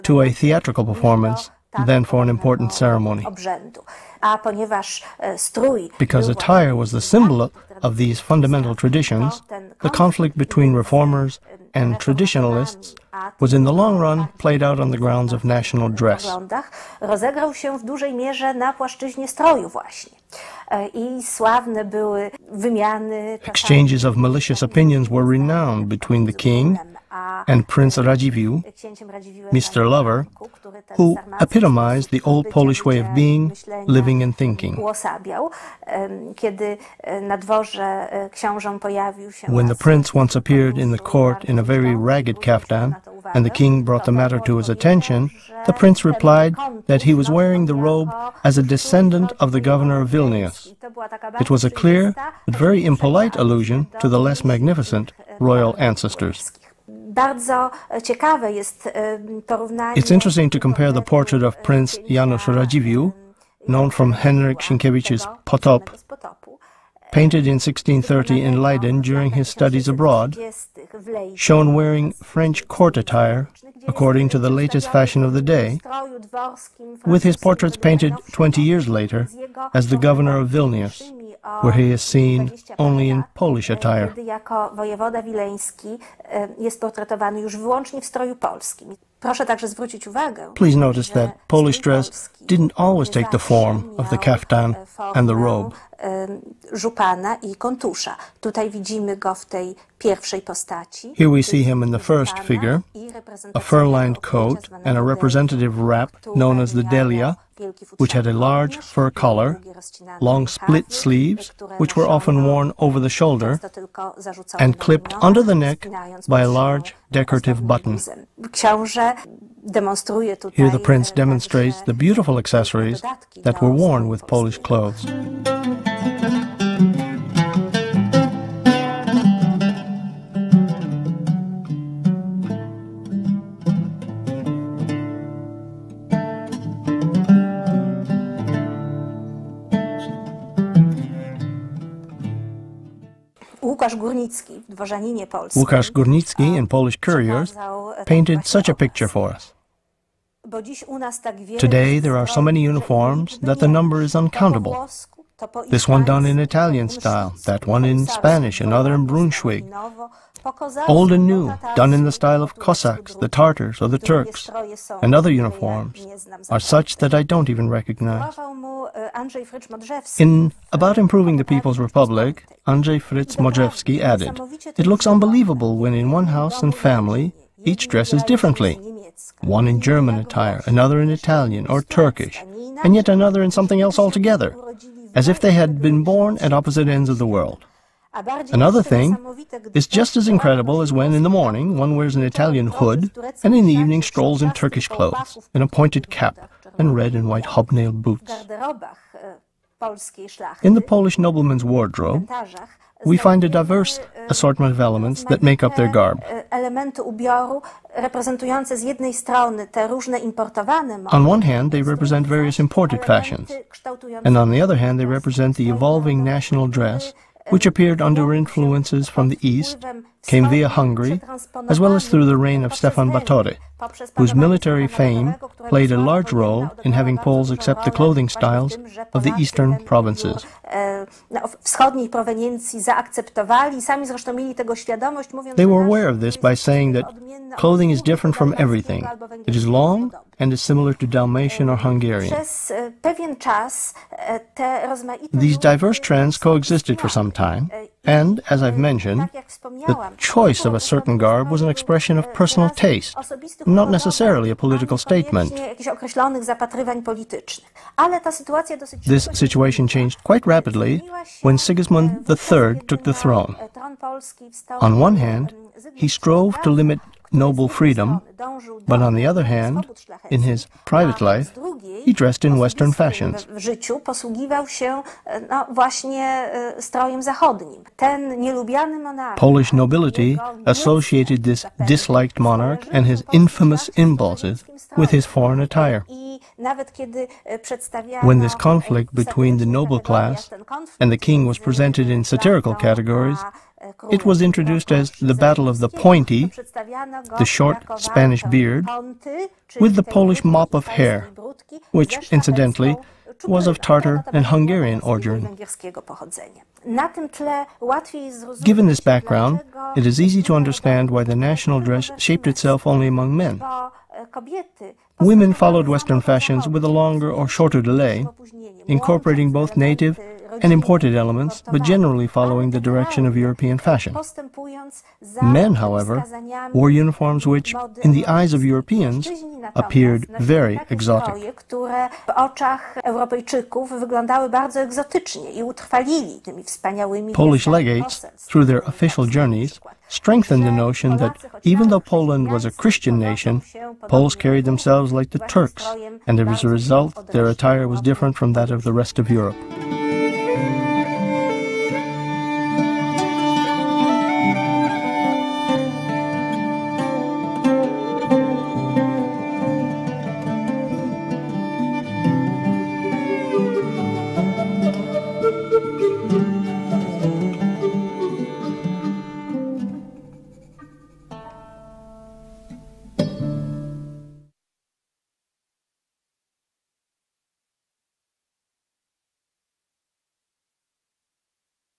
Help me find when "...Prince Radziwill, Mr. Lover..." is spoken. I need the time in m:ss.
0:27.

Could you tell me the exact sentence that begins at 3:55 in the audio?
They were aware of this by saying that clothing is different from everything.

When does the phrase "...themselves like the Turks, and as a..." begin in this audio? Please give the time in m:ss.
5:44.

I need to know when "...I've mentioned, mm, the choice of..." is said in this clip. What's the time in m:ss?
4:08.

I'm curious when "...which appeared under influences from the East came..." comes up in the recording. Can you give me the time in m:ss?
3:37.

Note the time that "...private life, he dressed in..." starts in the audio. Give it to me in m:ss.
4:30.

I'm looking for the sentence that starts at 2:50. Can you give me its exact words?
In About Improving the People's Republic, Andrzej Frycz Modrzewski added, It looks unbelievable when in one house and family, each dresses differently.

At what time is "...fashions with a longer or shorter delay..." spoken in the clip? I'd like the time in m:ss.
5:16.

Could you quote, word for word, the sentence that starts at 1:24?
Kiedy jako wojewoda wileński e, jest portretowany już wyłącznie w stroju polskim.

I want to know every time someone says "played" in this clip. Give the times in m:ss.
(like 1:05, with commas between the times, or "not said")
0:14, 3:45.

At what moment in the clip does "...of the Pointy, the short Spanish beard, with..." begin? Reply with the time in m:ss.
4:55.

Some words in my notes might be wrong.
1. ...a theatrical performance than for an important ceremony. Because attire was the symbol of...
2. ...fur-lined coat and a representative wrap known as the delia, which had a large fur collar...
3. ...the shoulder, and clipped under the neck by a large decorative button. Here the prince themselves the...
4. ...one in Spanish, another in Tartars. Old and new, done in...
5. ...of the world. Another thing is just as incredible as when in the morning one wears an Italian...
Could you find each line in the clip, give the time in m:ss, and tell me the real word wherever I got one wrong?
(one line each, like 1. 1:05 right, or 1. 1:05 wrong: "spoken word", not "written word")
1. 0:00 right
2. 1:43 right
3. 1:52 wrong: "demonstrates", not "themselves"
4. 2:37 wrong: "Brunswick", not "Tartars"
5. 3:07 right.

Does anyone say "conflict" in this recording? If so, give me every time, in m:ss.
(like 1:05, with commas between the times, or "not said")
0:09, 4:48.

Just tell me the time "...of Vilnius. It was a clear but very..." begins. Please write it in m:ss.
0:49.